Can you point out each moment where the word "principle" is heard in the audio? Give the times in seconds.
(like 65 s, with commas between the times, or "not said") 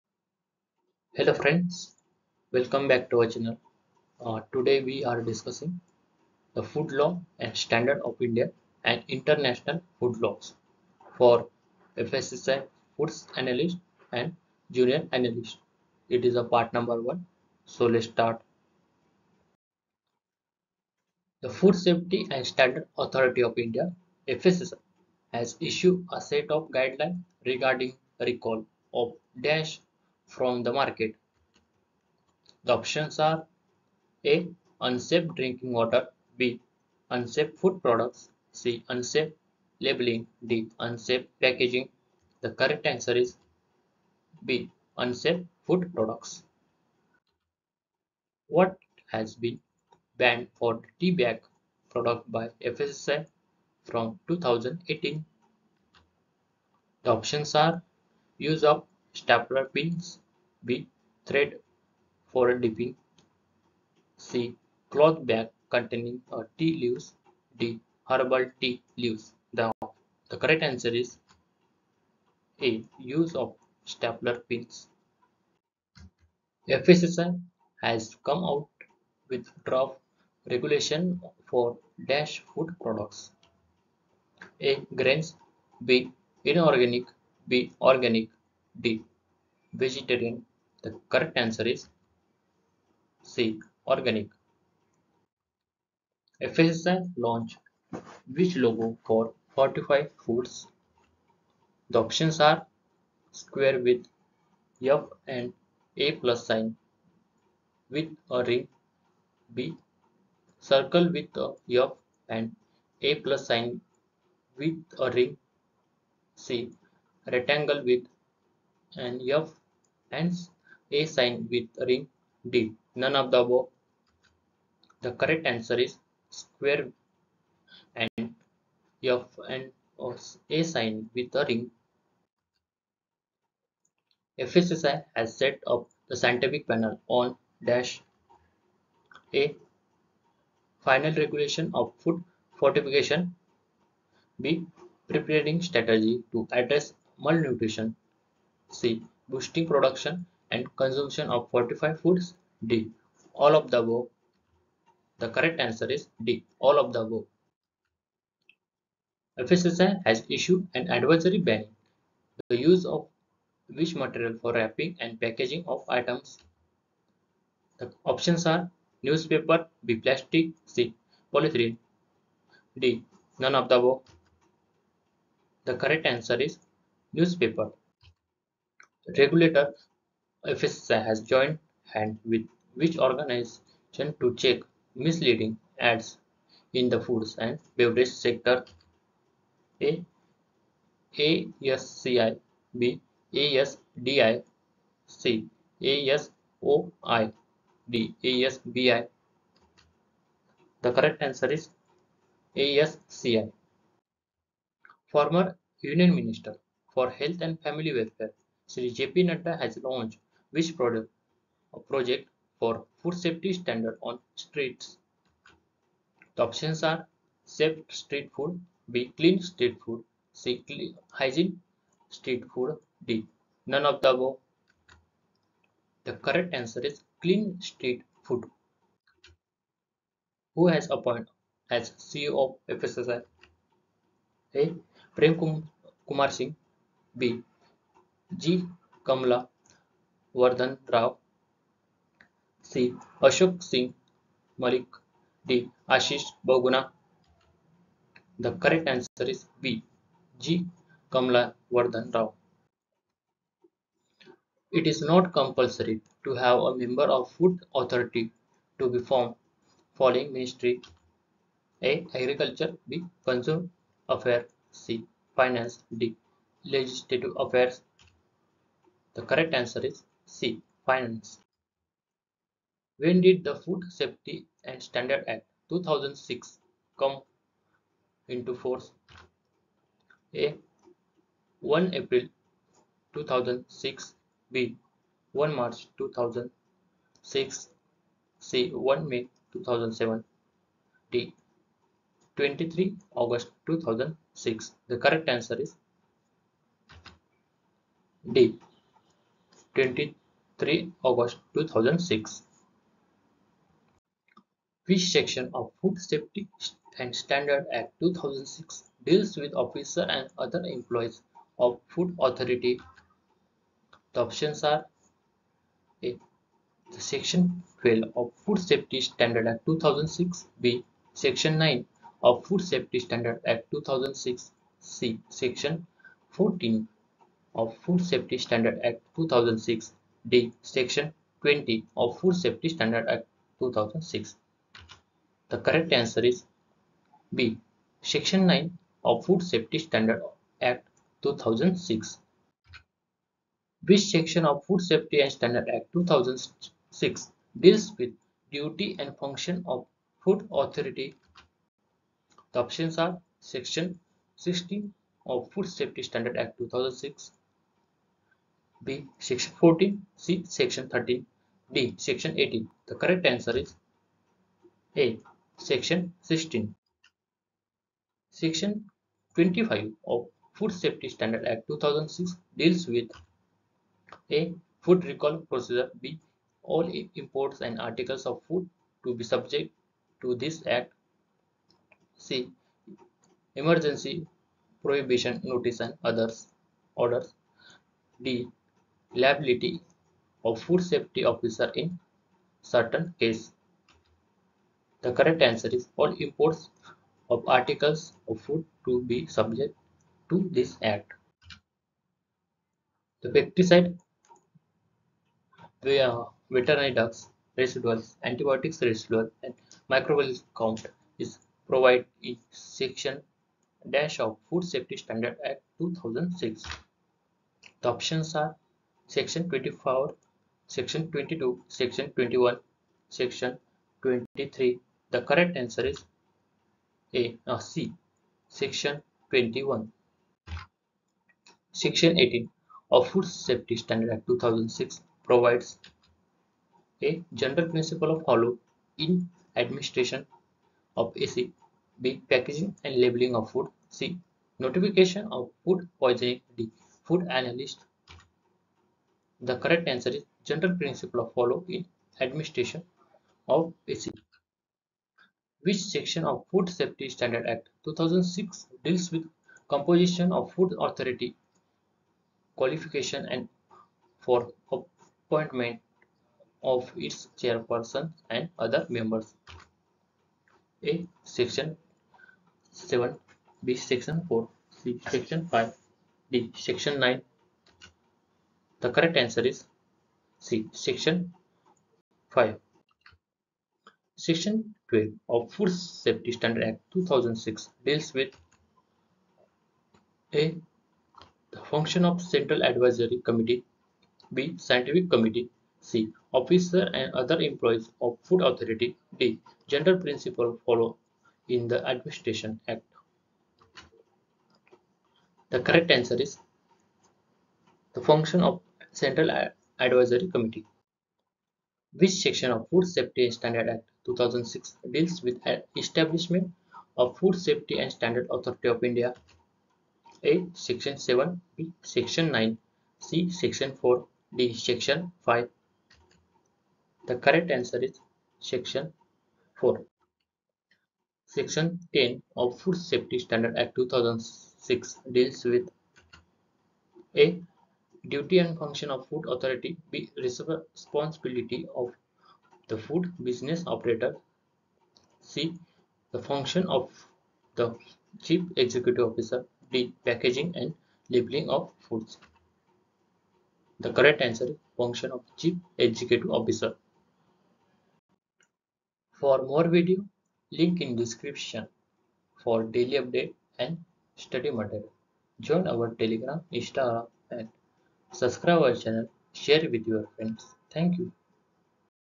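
437 s, 450 s, 499 s.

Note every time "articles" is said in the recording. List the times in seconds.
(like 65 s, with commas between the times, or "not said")
377 s, 397 s.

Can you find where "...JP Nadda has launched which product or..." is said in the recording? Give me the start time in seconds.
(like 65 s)
208 s.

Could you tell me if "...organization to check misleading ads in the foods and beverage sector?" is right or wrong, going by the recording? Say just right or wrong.
right.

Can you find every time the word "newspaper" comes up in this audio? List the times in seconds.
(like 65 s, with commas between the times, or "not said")
169 s, 177 s.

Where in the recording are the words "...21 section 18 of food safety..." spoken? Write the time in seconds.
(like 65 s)
429 s.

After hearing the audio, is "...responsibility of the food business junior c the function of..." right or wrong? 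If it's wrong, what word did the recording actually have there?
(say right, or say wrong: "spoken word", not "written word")
wrong: "operator", not "junior".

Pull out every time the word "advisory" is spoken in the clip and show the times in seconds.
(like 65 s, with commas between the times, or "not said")
160 s, 492 s, 509 s.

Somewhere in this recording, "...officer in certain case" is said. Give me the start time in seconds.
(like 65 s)
391 s.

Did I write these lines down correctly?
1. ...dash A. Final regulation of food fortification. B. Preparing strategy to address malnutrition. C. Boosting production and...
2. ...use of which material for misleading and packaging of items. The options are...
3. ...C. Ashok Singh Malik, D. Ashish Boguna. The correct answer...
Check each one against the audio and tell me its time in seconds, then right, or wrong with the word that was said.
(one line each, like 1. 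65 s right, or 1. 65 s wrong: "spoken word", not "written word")
1. 137 s right
2. 162 s wrong: "wrapping", not "misleading"
3. 242 s right.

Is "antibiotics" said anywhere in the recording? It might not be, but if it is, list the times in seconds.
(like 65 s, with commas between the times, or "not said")
408 s.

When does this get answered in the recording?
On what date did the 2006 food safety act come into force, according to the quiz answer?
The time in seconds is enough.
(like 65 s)
299 s.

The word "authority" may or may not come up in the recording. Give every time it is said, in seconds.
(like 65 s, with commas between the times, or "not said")
22 s, 257 s, 312 s, 350 s, 460 s, 498 s, 518 s, 539 s.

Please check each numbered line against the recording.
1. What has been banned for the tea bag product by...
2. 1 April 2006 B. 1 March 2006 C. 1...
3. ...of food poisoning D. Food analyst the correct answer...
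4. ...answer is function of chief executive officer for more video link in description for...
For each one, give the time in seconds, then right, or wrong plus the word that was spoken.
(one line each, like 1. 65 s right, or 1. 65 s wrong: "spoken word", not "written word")
1. 48 s right
2. 281 s right
3. 445 s right
4. 554 s right.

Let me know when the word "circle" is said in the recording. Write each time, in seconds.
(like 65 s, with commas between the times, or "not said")
110 s.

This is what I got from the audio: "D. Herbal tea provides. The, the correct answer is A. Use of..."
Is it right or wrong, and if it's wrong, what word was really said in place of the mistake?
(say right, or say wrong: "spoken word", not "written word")
wrong: "leaves", not "provides".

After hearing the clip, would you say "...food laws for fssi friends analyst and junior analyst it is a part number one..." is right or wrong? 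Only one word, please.
wrong.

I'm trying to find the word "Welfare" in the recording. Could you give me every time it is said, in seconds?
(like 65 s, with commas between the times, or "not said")
207 s.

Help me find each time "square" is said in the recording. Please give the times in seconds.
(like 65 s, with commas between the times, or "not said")
103 s, 126 s.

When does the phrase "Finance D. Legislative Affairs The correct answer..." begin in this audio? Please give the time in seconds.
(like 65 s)
265 s.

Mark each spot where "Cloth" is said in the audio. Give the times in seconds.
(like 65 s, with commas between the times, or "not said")
64 s.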